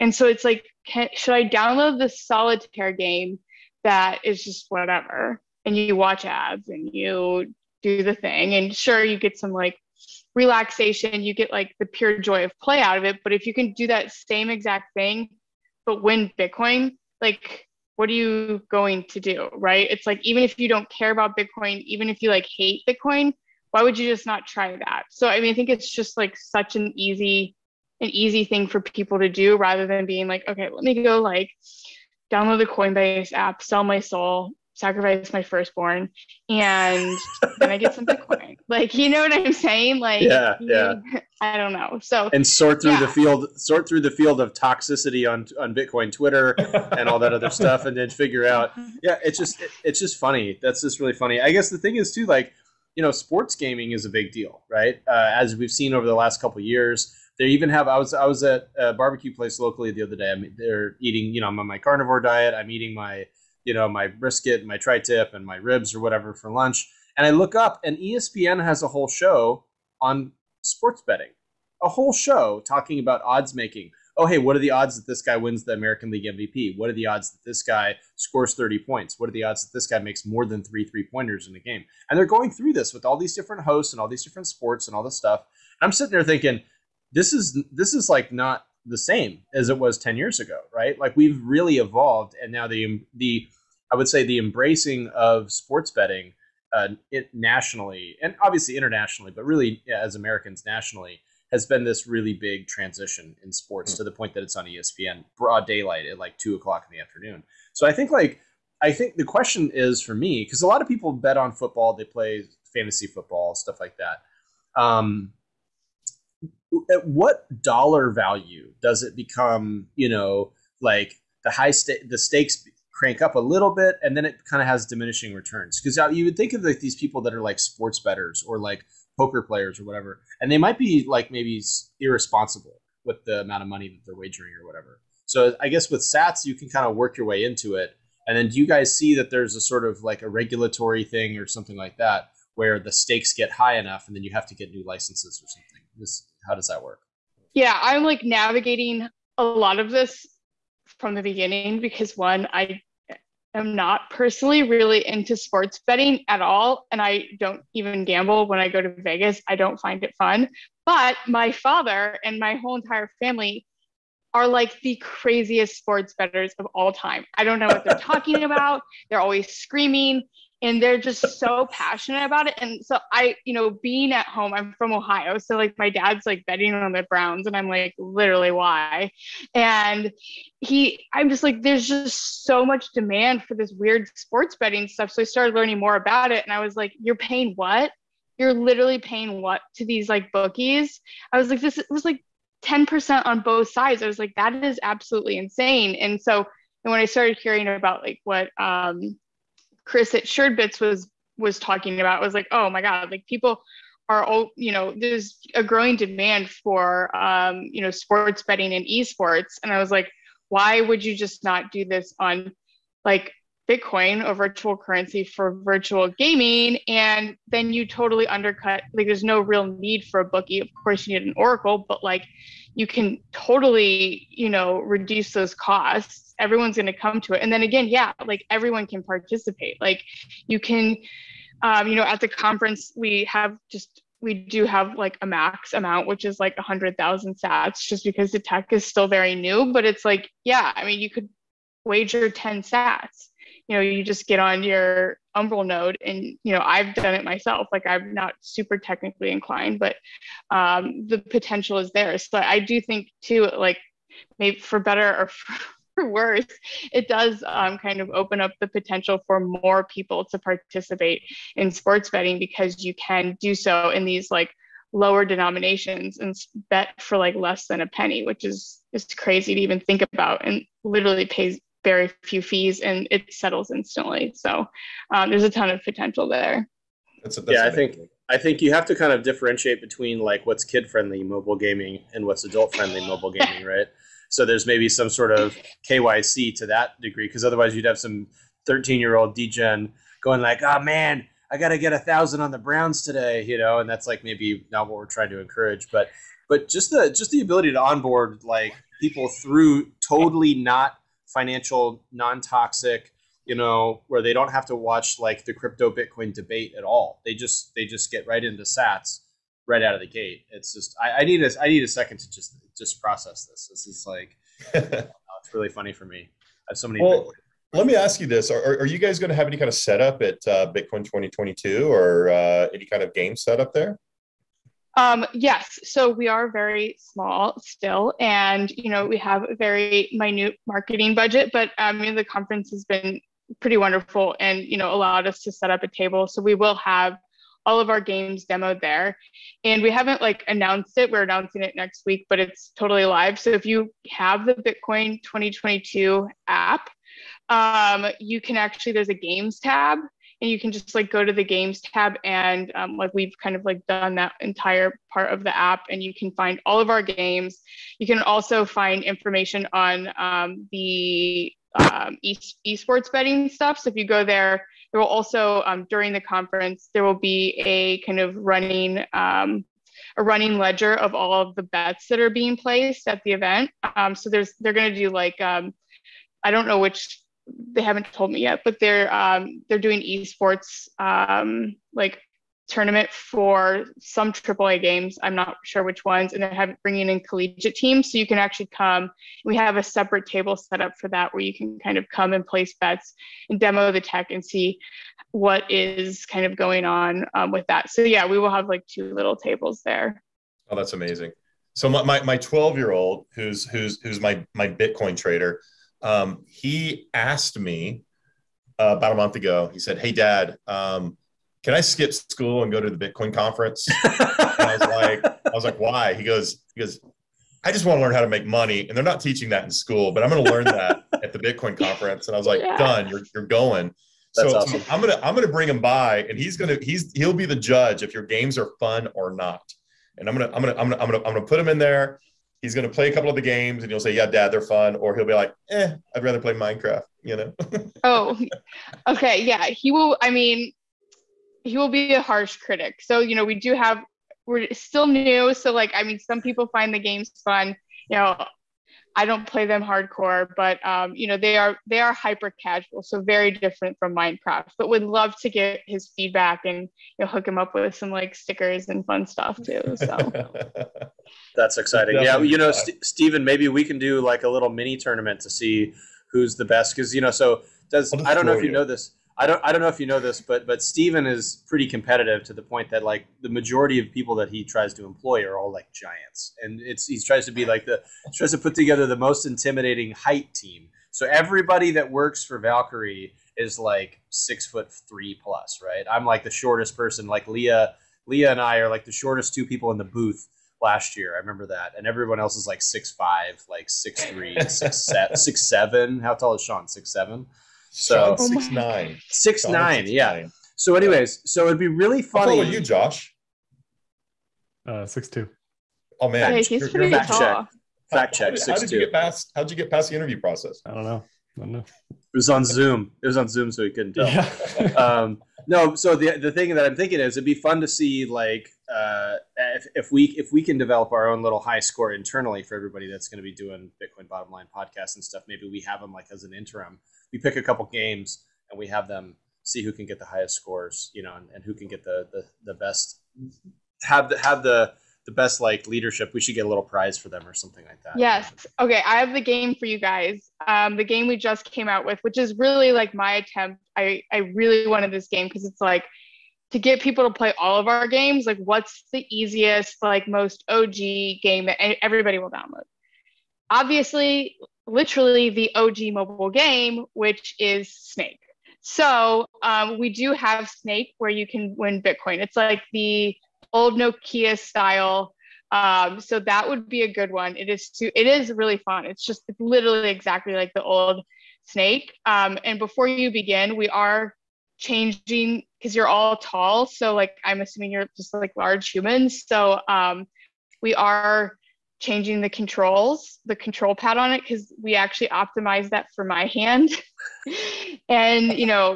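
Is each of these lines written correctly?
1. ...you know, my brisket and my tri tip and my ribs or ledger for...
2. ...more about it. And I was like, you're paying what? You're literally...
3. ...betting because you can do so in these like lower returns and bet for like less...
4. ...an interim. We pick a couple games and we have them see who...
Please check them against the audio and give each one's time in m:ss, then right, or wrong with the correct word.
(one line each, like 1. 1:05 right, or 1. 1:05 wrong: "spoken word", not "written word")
1. 1:03 wrong: "whatever", not "ledger"
2. 3:05 right
3. 4:22 wrong: "denominations", not "returns"
4. 8:46 right.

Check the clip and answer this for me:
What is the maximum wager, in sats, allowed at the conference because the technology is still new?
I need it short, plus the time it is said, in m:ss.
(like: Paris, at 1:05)
100000 sats, at 3:56.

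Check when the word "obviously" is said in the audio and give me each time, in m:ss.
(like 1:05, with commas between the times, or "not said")
1:38, 9:13.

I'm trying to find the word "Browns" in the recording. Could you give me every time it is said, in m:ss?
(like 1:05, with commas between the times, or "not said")
2:57, 4:52.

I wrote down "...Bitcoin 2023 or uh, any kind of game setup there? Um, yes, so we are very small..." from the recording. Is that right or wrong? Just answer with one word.
wrong.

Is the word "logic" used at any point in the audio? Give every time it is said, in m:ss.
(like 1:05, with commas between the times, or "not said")
not said.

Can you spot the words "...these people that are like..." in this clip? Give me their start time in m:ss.
2:06.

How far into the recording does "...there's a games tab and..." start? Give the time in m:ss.
5:48.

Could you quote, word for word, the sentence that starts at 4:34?
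So um, there's a ton of potential there.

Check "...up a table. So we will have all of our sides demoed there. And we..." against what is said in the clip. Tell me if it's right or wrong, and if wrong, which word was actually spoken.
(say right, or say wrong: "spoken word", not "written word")
wrong: "games", not "sides".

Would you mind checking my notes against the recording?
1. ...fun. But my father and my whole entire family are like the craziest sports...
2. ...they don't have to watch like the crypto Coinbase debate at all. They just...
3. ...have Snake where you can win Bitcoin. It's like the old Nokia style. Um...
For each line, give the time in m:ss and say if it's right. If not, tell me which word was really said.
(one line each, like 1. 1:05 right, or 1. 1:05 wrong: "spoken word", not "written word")
1. 2:40 right
2. 5:04 wrong: "Bitcoin", not "Coinbase"
3. 9:20 right.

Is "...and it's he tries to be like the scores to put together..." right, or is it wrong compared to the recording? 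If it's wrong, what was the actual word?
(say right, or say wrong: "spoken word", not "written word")
wrong: "tries", not "scores".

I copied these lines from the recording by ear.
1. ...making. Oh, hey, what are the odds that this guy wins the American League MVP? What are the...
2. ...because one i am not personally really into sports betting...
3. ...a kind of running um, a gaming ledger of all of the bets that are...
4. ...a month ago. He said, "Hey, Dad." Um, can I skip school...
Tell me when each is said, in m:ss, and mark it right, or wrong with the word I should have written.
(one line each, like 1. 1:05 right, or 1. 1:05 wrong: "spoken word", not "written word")
1. 1:13 right
2. 2:31 right
3. 6:07 wrong: "running", not "gaming"
4. 6:49 right.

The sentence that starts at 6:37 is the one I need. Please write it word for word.
So yeah, we will have like two little tables there.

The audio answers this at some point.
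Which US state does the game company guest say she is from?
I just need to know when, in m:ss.
2:54.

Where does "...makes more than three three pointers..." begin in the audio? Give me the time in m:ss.
1:19.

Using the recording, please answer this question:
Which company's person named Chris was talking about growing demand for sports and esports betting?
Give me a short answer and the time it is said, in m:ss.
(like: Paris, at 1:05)
Suredbits, at 3:20.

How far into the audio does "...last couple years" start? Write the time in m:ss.
0:56.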